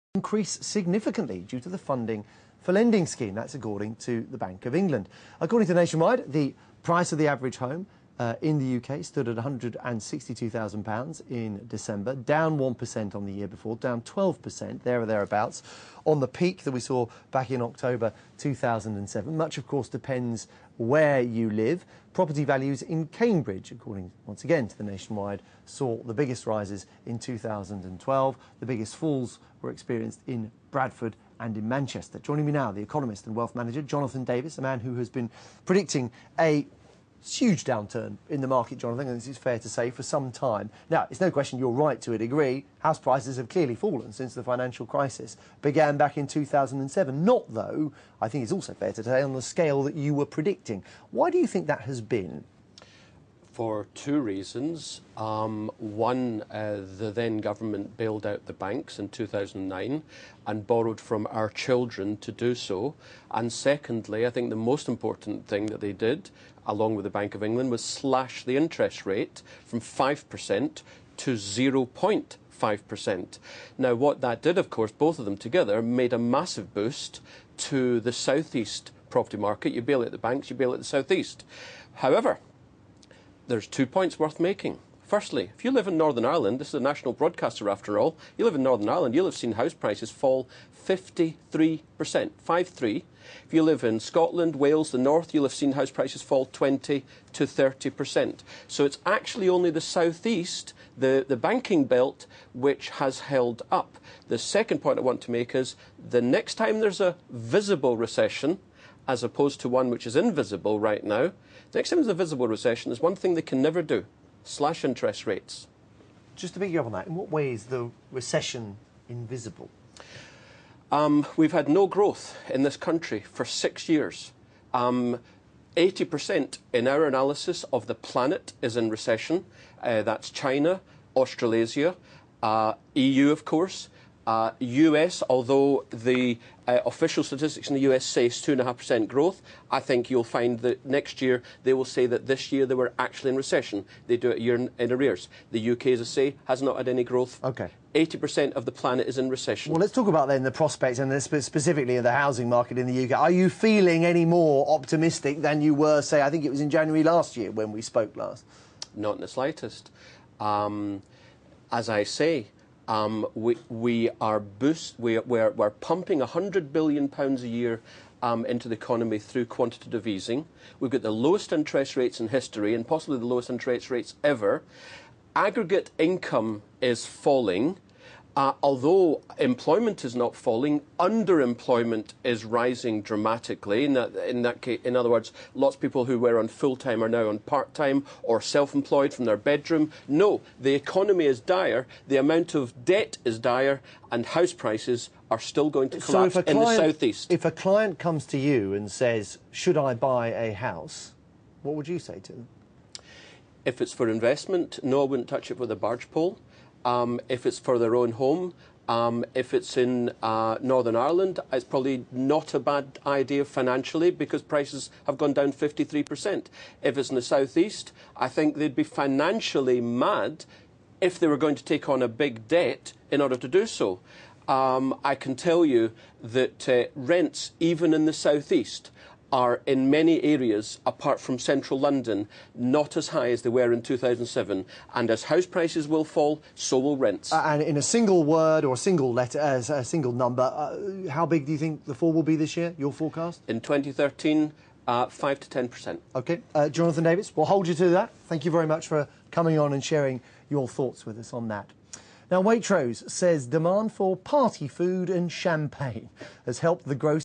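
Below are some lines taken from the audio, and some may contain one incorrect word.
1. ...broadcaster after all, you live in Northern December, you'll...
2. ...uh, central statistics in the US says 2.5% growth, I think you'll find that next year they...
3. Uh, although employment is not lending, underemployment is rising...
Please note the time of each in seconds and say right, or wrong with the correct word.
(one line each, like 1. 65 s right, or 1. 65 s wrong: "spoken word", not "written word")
1. 87 s wrong: "Ireland", not "December"
2. 136 s wrong: "official", not "central"
3. 178 s wrong: "falling", not "lending".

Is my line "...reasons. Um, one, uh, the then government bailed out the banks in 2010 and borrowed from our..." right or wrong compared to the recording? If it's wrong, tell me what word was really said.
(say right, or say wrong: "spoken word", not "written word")
wrong: "2009", not "2010".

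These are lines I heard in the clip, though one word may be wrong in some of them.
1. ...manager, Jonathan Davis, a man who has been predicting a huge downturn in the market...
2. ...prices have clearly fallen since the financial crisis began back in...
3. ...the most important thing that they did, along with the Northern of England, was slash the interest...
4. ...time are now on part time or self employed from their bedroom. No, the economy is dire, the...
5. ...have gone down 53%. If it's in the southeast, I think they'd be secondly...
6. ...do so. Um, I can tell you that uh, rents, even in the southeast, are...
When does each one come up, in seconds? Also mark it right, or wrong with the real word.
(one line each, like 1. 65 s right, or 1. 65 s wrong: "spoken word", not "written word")
1. 33 s right
2. 42 s right
3. 64 s wrong: "Bank", not "Northern"
4. 186 s right
5. 215 s wrong: "financially", not "secondly"
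6. 223 s right.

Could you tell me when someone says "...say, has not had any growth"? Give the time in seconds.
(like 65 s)
146 s.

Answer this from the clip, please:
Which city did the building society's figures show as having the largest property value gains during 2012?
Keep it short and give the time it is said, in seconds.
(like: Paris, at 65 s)
Cambridge, at 23 s.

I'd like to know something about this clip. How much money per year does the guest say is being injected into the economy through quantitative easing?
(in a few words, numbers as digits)
£100 billion.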